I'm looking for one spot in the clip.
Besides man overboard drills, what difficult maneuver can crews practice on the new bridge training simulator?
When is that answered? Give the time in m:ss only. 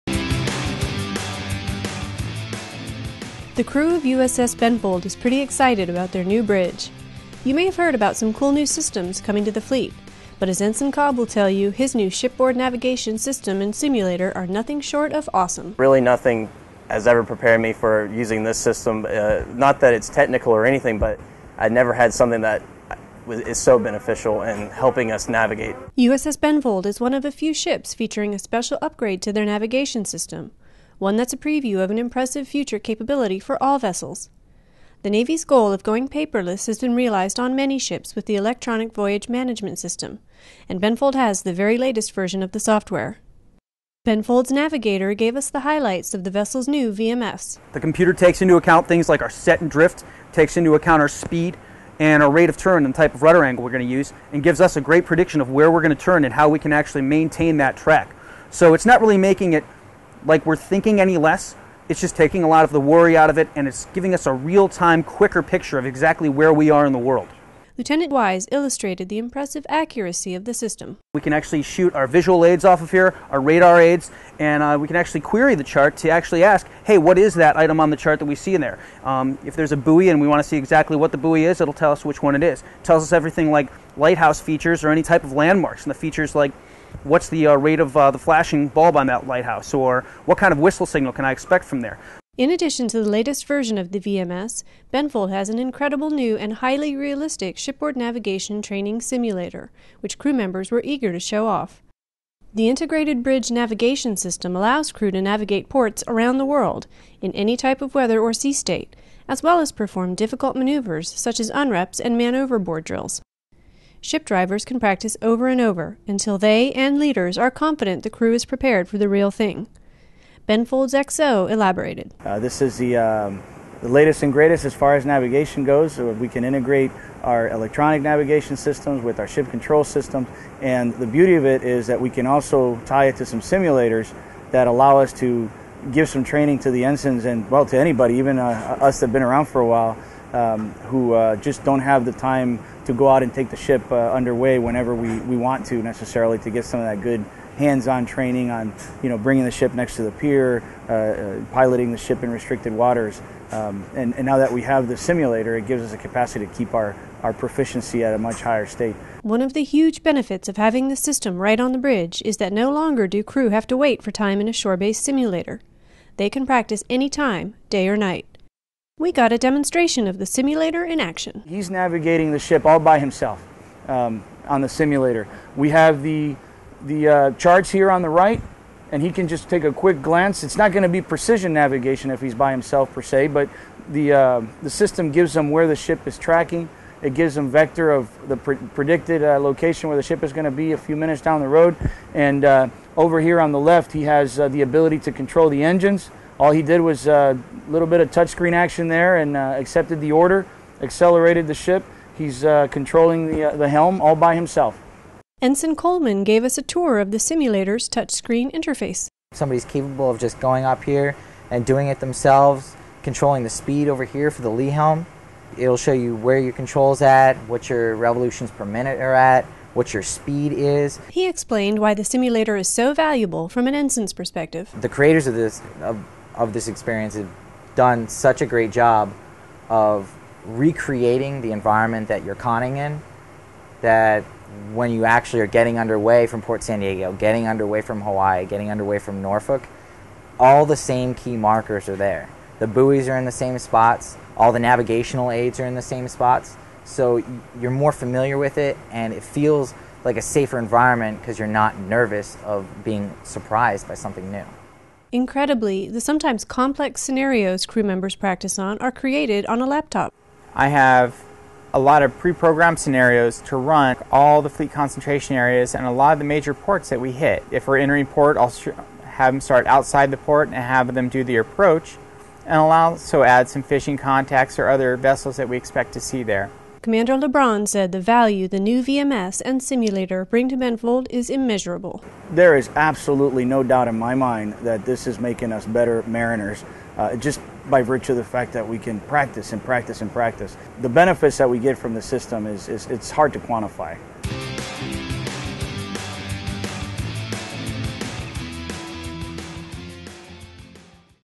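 1:51.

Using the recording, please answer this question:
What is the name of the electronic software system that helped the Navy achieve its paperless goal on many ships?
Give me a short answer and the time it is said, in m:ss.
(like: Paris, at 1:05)
Electronic Voyage Management System, at 0:38.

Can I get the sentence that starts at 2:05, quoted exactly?
So we can integrate our electronic navigation systems with our ship control systems.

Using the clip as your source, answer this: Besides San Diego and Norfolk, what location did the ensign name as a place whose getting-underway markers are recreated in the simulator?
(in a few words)
Hawaii.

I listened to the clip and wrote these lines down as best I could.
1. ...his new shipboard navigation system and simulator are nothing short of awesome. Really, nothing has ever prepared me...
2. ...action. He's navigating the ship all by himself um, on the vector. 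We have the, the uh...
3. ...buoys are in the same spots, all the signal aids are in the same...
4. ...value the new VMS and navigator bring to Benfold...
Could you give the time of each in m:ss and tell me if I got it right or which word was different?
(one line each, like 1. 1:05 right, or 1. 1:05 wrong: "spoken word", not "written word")
1. 0:11 right
2. 2:50 wrong: "simulator", not "vector"
3. 4:02 wrong: "navigational", not "signal"
4. 4:38 wrong: "simulator", not "navigator".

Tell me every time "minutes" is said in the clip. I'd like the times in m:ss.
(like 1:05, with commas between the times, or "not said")
3:10, 3:38.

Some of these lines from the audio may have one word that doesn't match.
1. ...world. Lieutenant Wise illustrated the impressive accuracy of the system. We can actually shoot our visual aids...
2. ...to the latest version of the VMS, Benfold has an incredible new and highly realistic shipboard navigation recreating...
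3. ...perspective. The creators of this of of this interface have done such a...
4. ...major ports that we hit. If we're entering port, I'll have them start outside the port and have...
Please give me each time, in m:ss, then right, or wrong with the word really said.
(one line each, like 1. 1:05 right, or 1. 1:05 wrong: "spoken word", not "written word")
1. 1:06 right
2. 1:32 wrong: "training", not "recreating"
3. 3:44 wrong: "experience", not "interface"
4. 4:26 right.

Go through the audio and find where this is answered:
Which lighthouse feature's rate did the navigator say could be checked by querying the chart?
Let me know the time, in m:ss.
1:28.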